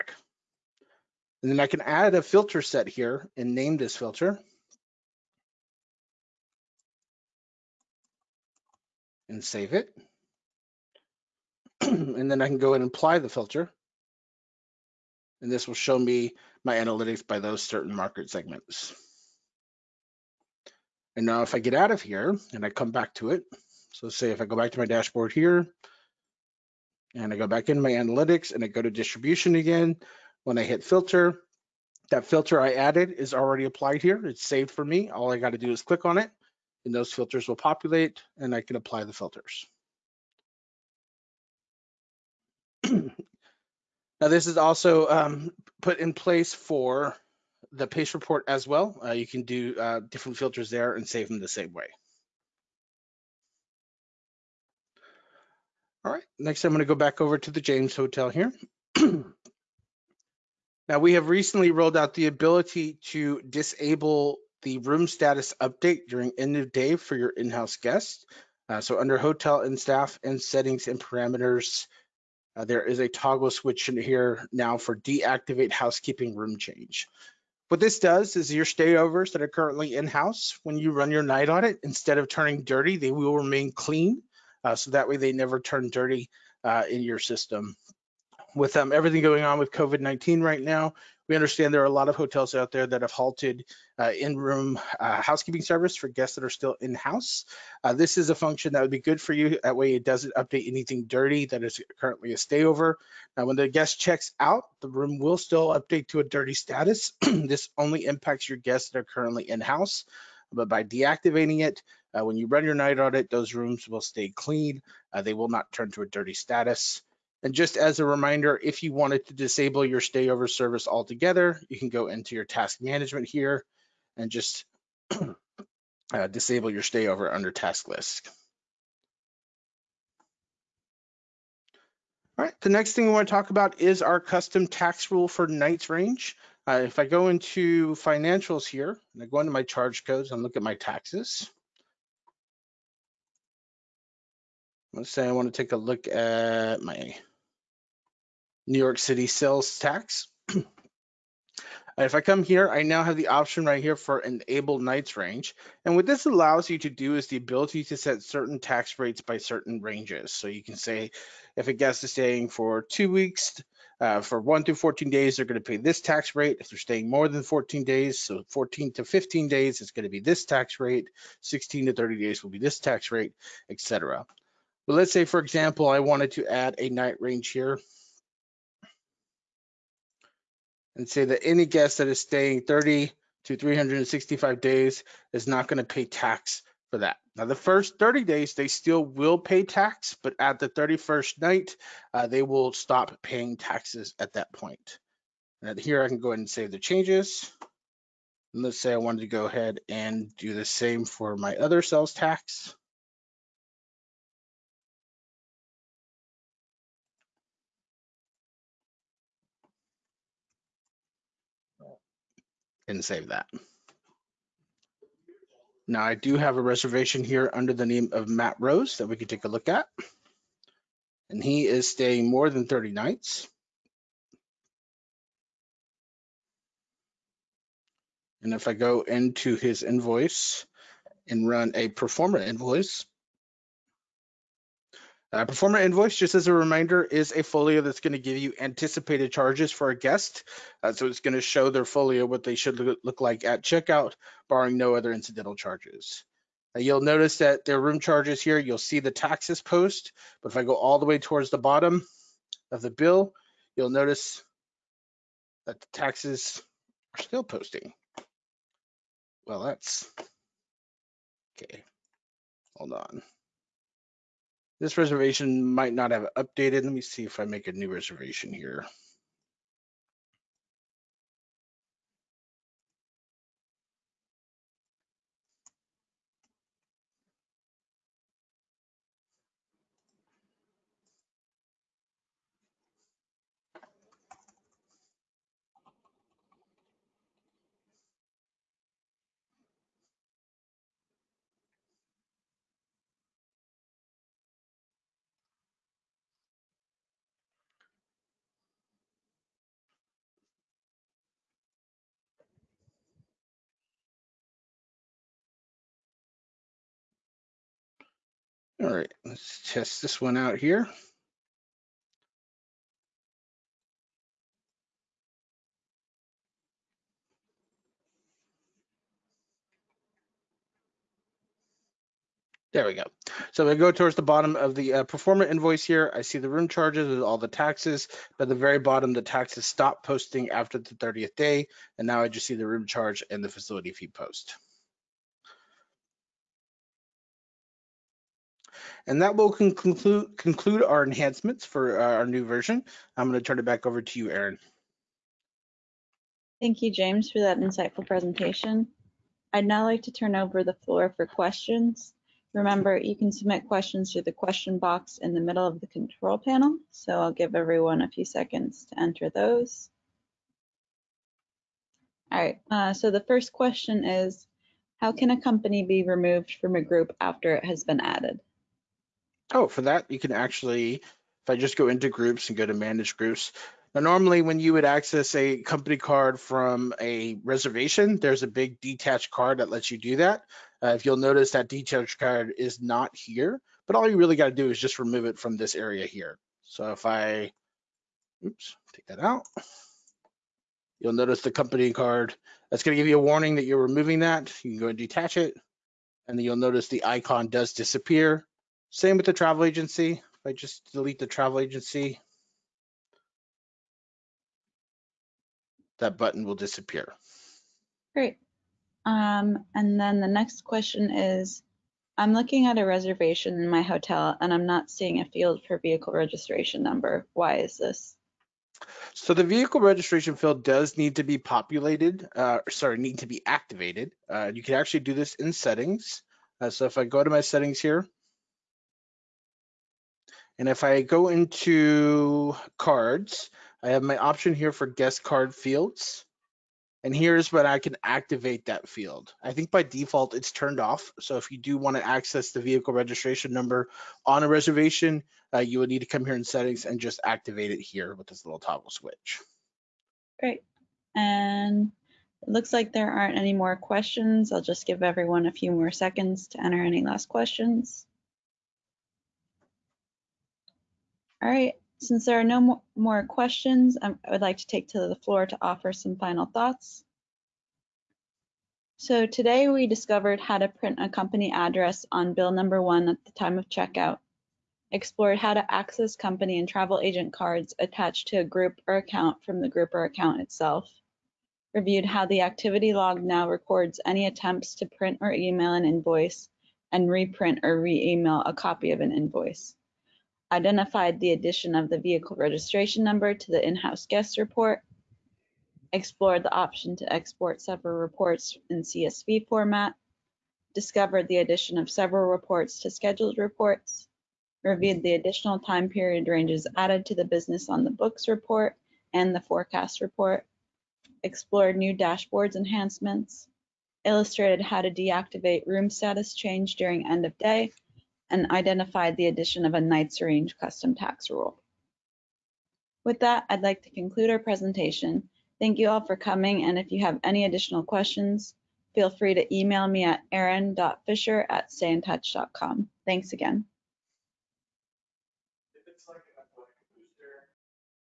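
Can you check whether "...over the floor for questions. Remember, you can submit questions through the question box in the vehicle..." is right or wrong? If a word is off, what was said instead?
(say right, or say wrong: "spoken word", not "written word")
wrong: "middle", not "vehicle".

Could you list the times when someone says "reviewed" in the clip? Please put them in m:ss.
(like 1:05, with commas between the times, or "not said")
8:01, 8:24.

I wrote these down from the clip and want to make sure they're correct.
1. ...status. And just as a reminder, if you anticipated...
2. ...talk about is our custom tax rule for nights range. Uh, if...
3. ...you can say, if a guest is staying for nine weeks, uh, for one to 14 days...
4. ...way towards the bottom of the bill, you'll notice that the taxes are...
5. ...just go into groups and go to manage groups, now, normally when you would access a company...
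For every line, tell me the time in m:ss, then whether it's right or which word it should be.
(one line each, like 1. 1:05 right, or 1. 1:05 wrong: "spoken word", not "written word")
1. 1:56 wrong: "wanted", not "anticipated"
2. 2:13 right
3. 2:40 wrong: "two", not "nine"
4. 4:11 right
5. 6:11 right.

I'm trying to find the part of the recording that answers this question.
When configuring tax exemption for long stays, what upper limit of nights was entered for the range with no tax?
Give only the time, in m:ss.
3:03.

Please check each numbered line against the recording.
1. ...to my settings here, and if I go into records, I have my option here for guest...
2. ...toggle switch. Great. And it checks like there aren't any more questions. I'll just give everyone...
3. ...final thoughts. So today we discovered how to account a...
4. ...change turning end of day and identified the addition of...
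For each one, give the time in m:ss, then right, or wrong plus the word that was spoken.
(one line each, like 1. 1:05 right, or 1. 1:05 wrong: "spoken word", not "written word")
1. 7:07 wrong: "cards", not "records"
2. 7:28 wrong: "looks", not "checks"
3. 7:46 wrong: "print", not "account"
4. 8:36 wrong: "during", not "turning".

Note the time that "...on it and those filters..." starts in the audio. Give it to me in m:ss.
0:36.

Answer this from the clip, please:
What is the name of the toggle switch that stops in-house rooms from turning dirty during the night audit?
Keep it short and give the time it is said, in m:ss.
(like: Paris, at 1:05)
Deactivate housekeeping room change, at 1:14.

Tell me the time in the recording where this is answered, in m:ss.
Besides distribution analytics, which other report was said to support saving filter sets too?
0:47.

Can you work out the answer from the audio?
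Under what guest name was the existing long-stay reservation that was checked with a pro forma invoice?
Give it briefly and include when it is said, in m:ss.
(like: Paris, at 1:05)
Matt Rose, at 3:38.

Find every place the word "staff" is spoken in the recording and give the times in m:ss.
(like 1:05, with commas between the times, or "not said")
1:09.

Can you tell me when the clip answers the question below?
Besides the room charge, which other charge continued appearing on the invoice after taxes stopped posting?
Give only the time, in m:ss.
5:33.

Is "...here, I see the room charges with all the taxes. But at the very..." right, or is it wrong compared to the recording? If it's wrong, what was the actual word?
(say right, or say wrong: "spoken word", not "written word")
right.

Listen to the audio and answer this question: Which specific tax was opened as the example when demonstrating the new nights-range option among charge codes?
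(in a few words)
New York City sales tax.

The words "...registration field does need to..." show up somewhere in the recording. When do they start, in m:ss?
6:59.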